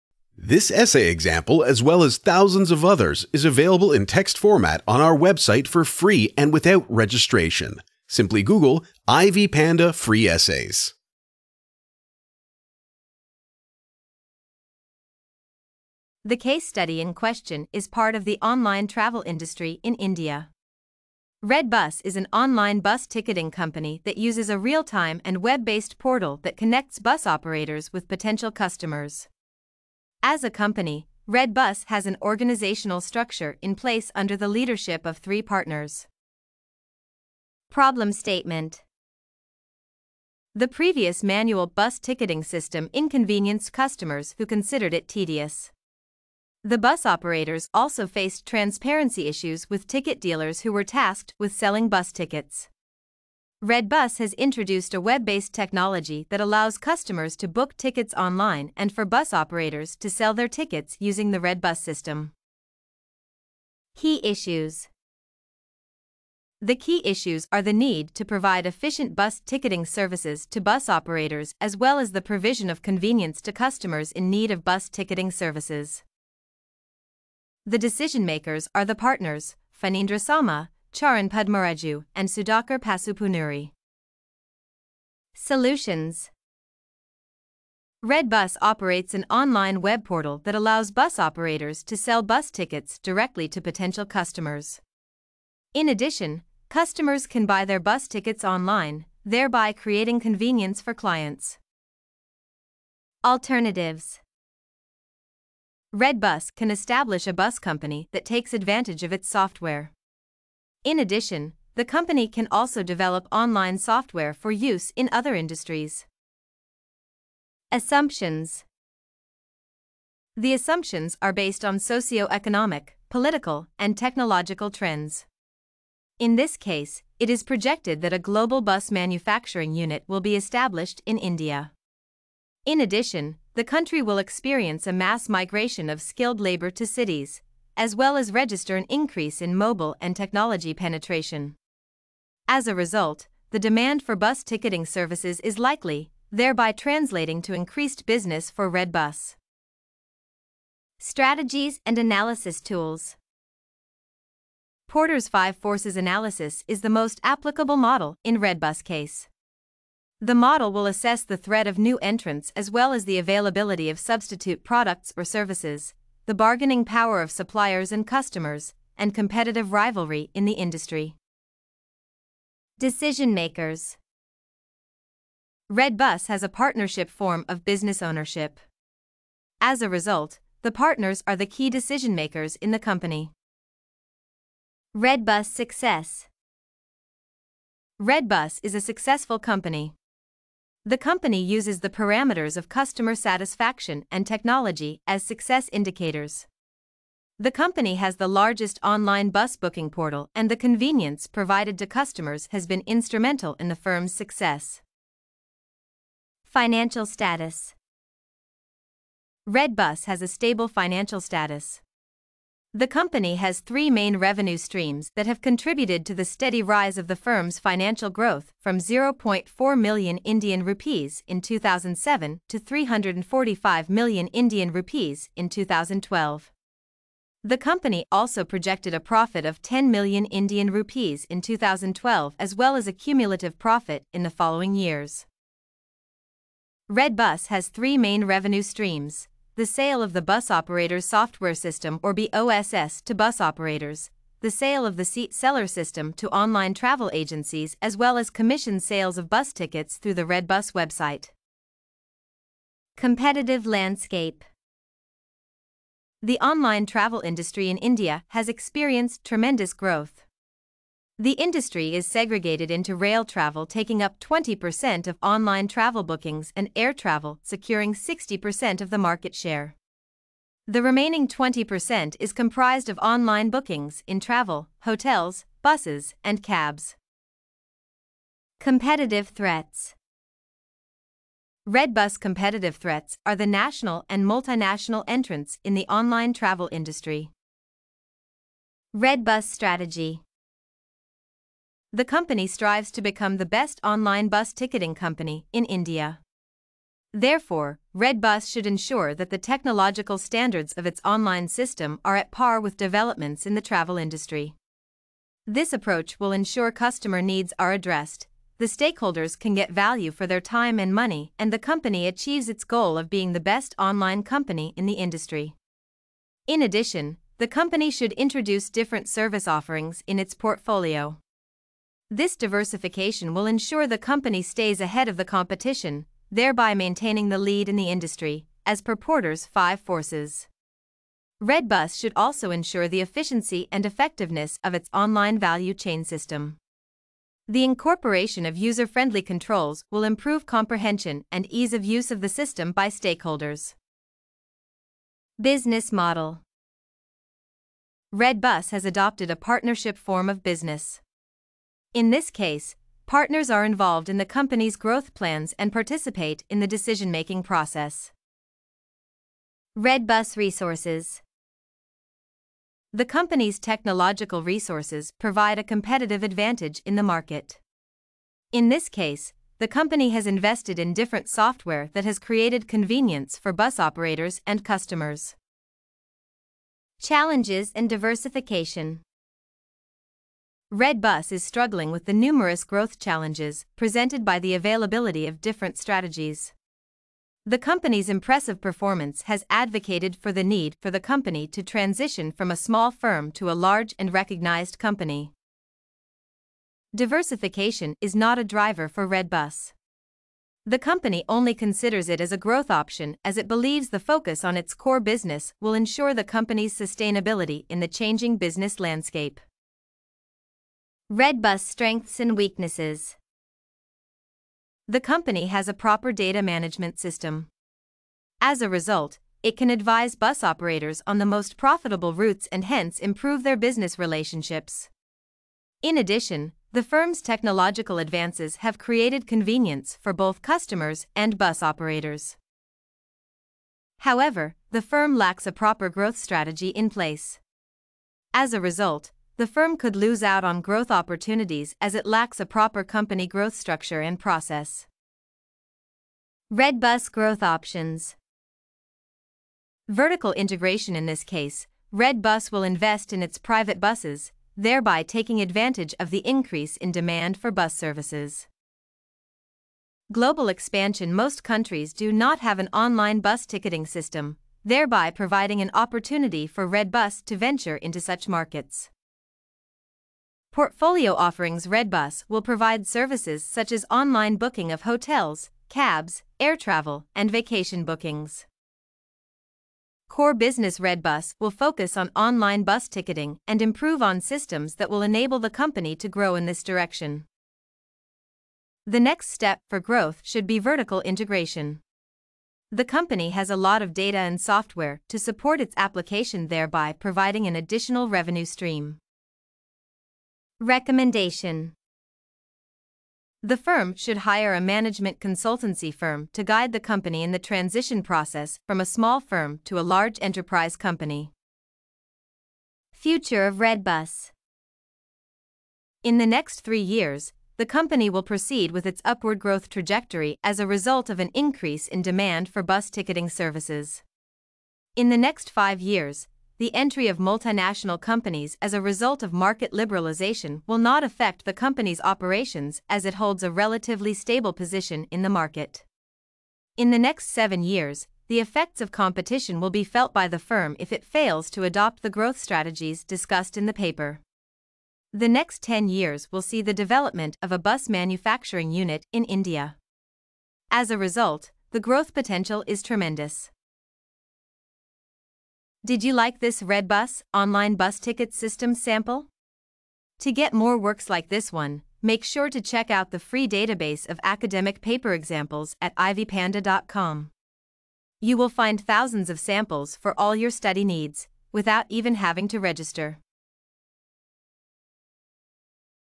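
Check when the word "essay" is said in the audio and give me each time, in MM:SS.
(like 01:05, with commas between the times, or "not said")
00:00, 00:10.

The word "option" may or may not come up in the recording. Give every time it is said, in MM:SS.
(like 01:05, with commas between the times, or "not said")
06:42, 07:27.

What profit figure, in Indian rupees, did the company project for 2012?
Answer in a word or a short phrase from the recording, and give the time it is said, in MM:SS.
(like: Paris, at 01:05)
10 million, at 03:49.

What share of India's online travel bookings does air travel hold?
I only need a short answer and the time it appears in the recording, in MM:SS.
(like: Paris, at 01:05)
60%, at 04:27.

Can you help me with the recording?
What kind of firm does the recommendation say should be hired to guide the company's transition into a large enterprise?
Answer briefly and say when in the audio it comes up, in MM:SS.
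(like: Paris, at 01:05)
Management consultancy firm, at 08:24.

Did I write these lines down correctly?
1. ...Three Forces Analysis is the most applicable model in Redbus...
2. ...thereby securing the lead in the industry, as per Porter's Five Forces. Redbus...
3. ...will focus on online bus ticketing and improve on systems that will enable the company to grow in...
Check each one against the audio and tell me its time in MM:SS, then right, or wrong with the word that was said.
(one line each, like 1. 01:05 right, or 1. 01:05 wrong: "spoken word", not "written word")
1. 02:35 wrong: "Five", not "Three"
2. 05:26 wrong: "maintaining", not "securing"
3. 08:01 right.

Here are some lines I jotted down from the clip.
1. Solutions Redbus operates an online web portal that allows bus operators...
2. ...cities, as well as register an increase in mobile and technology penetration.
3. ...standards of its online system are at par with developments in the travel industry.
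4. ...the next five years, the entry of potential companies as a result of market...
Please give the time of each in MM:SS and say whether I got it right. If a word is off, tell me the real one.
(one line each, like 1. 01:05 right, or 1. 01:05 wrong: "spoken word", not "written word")
1. 01:25 right
2. 02:16 right
3. 05:00 right
4. 08:45 wrong: "multinational", not "potential".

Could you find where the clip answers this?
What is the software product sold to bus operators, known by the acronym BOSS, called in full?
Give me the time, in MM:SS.
04:00.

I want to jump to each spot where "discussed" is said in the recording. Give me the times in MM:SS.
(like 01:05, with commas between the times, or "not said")
09:03.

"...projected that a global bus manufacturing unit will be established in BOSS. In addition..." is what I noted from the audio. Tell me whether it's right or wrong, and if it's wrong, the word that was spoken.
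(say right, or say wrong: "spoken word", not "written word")
wrong: "India", not "BOSS".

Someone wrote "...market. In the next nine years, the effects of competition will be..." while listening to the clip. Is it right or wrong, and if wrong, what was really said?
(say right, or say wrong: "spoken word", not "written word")
wrong: "seven", not "nine".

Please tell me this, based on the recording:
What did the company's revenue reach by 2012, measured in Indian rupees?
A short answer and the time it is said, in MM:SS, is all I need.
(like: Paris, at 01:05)
345 million, at 03:42.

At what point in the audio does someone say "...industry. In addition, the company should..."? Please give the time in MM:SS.
05:15.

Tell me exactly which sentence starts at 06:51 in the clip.
Redbus Strengths and Weaknesses The company has a proper data management system.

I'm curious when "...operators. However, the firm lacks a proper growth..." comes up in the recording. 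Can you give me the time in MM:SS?
07:11.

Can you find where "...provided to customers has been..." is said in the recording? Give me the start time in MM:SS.
03:21.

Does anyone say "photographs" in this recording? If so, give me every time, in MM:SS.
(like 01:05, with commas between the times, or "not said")
not said.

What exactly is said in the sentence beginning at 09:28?
You will find thousands of samples for all your study needs, without even having to register.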